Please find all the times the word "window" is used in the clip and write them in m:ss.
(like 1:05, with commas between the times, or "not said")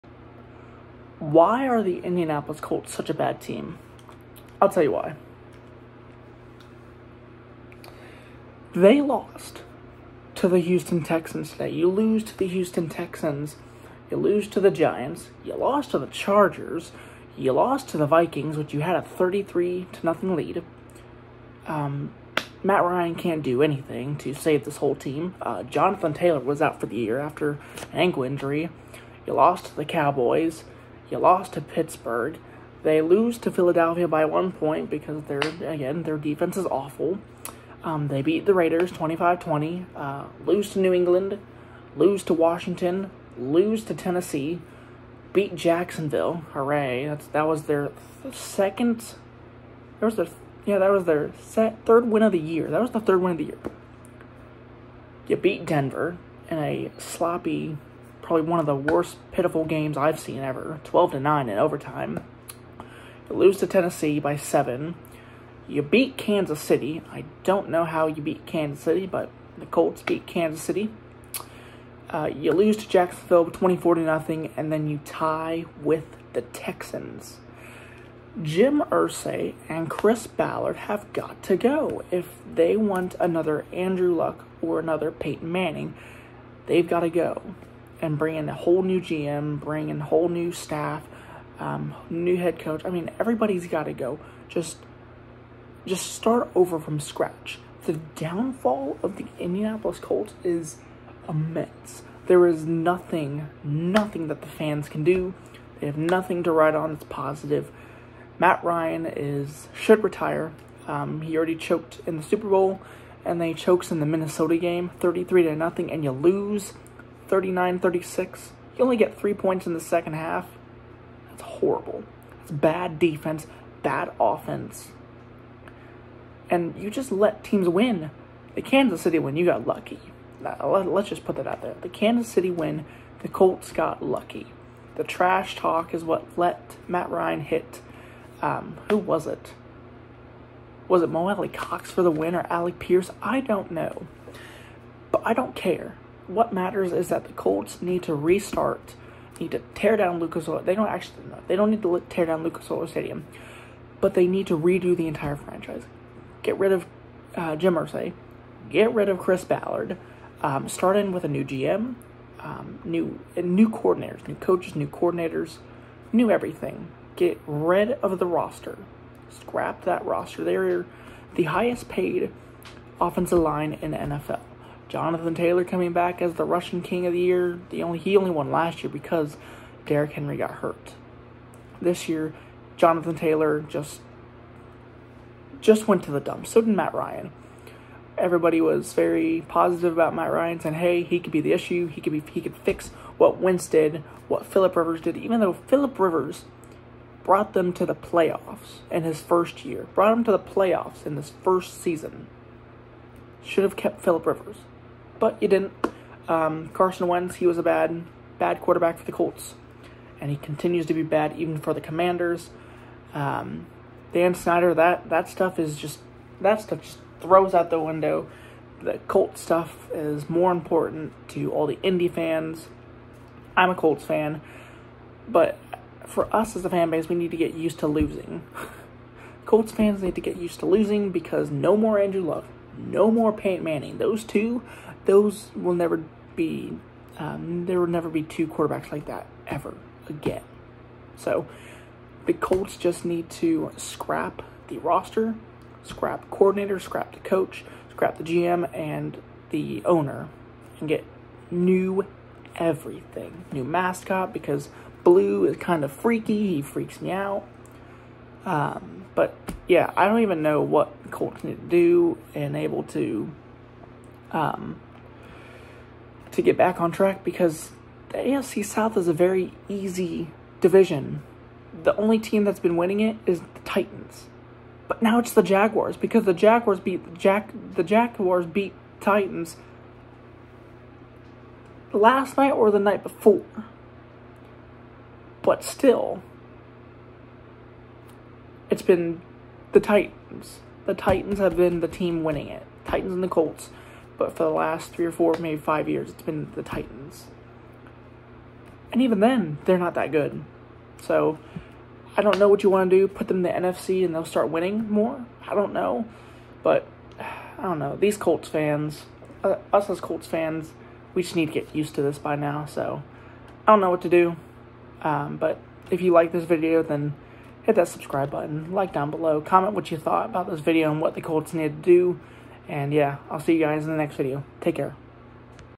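3:37.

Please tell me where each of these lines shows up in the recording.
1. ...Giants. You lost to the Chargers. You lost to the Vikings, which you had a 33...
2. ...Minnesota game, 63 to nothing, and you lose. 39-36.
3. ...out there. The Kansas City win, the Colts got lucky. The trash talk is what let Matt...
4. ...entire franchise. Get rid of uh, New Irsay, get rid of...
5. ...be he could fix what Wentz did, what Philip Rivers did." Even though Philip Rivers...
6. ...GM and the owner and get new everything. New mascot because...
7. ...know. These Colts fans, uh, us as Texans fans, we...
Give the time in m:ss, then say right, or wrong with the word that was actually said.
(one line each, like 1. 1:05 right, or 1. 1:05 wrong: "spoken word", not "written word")
1. 0:14 right
2. 1:54 wrong: "33", not "63"
3. 2:11 right
4. 2:35 wrong: "Jim", not "New"
5. 3:12 right
6. 4:08 right
7. 5:07 wrong: "Colts", not "Texans".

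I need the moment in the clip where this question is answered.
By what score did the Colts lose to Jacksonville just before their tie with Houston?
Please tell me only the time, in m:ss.
1:13.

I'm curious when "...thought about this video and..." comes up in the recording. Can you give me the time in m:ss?
5:19.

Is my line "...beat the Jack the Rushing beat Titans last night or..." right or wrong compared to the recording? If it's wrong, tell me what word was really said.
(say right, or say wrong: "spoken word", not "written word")
wrong: "Jaguars", not "Rushing".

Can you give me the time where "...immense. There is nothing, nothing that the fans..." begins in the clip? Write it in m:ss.
1:41.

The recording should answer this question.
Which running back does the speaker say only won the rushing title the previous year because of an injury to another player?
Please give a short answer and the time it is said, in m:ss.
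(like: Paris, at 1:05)
Derrick Henry, at 2:59.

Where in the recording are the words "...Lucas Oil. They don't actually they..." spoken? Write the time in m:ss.
2:30.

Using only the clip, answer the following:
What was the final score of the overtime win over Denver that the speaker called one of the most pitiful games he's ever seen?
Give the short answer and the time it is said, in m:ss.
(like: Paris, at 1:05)
12 to 9, at 1:00.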